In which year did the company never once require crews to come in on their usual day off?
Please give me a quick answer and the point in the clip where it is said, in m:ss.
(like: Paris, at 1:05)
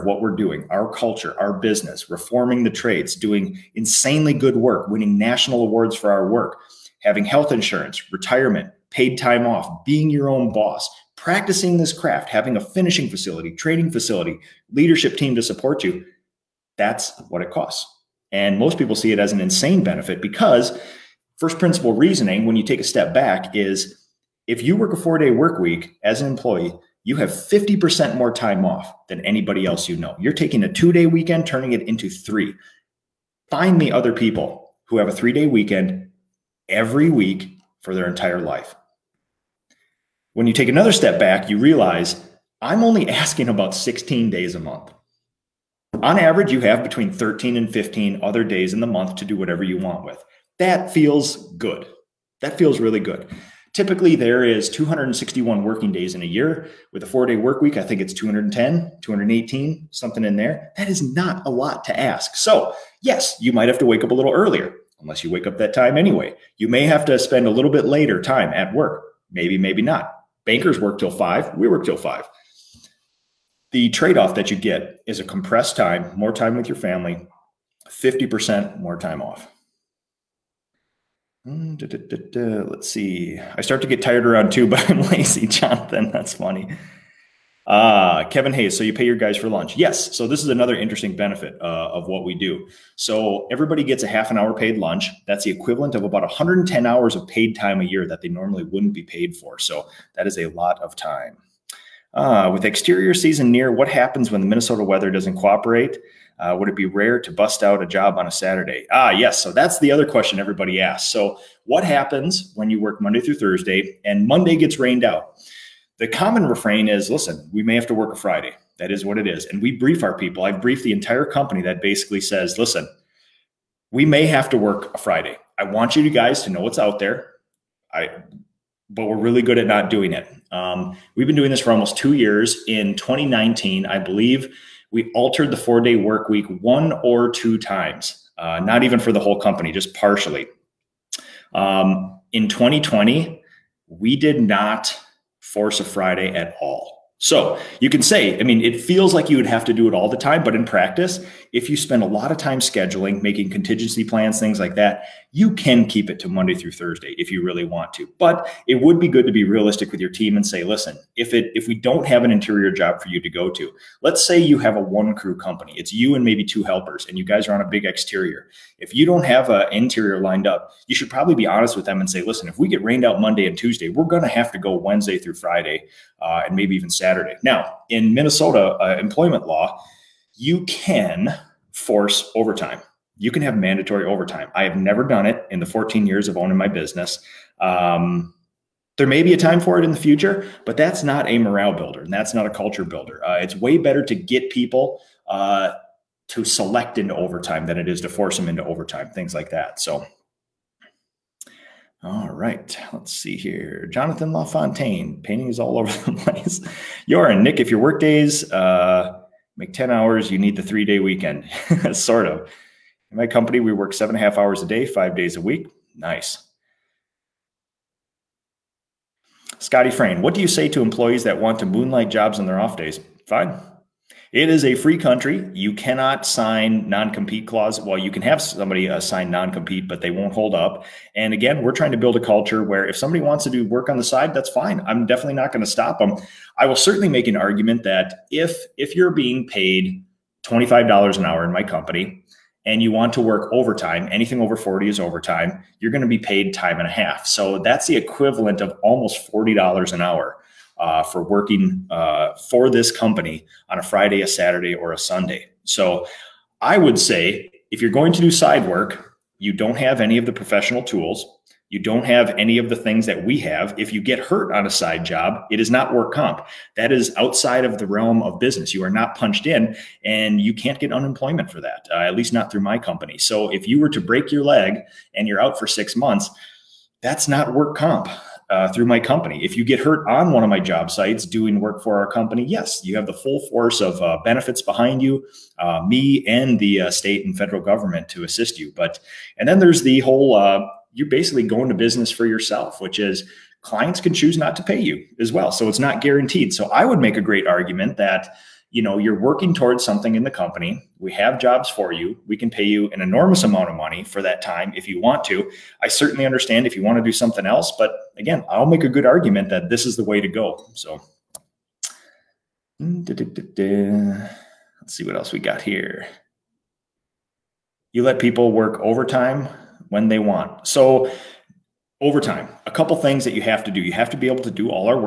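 2020, at 2:22.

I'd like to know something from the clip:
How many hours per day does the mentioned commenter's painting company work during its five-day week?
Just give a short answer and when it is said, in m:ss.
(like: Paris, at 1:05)
7.5, at 3:33.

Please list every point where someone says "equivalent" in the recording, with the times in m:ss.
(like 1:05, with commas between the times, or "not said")
1:35, 4:07.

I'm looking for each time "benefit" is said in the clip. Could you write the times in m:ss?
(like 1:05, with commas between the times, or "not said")
0:19, 1:31, 4:44.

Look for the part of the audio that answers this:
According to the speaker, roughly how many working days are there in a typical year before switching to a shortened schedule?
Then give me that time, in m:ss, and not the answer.
0:54.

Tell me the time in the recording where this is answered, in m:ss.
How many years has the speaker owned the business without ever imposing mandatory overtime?
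3:05.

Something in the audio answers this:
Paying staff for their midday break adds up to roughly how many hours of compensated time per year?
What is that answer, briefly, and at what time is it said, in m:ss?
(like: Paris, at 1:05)
110 hours, at 1:36.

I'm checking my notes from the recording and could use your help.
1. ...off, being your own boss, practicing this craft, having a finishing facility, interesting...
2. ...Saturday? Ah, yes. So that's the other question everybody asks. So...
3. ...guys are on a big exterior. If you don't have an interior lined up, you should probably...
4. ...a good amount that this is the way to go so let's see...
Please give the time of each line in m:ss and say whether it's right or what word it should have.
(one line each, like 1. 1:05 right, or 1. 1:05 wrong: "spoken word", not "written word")
1. 0:09 wrong: "training", not "interesting"
2. 1:48 right
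3. 2:47 right
4. 5:08 wrong: "argument", not "amount".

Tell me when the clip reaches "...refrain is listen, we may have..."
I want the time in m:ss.
1:56.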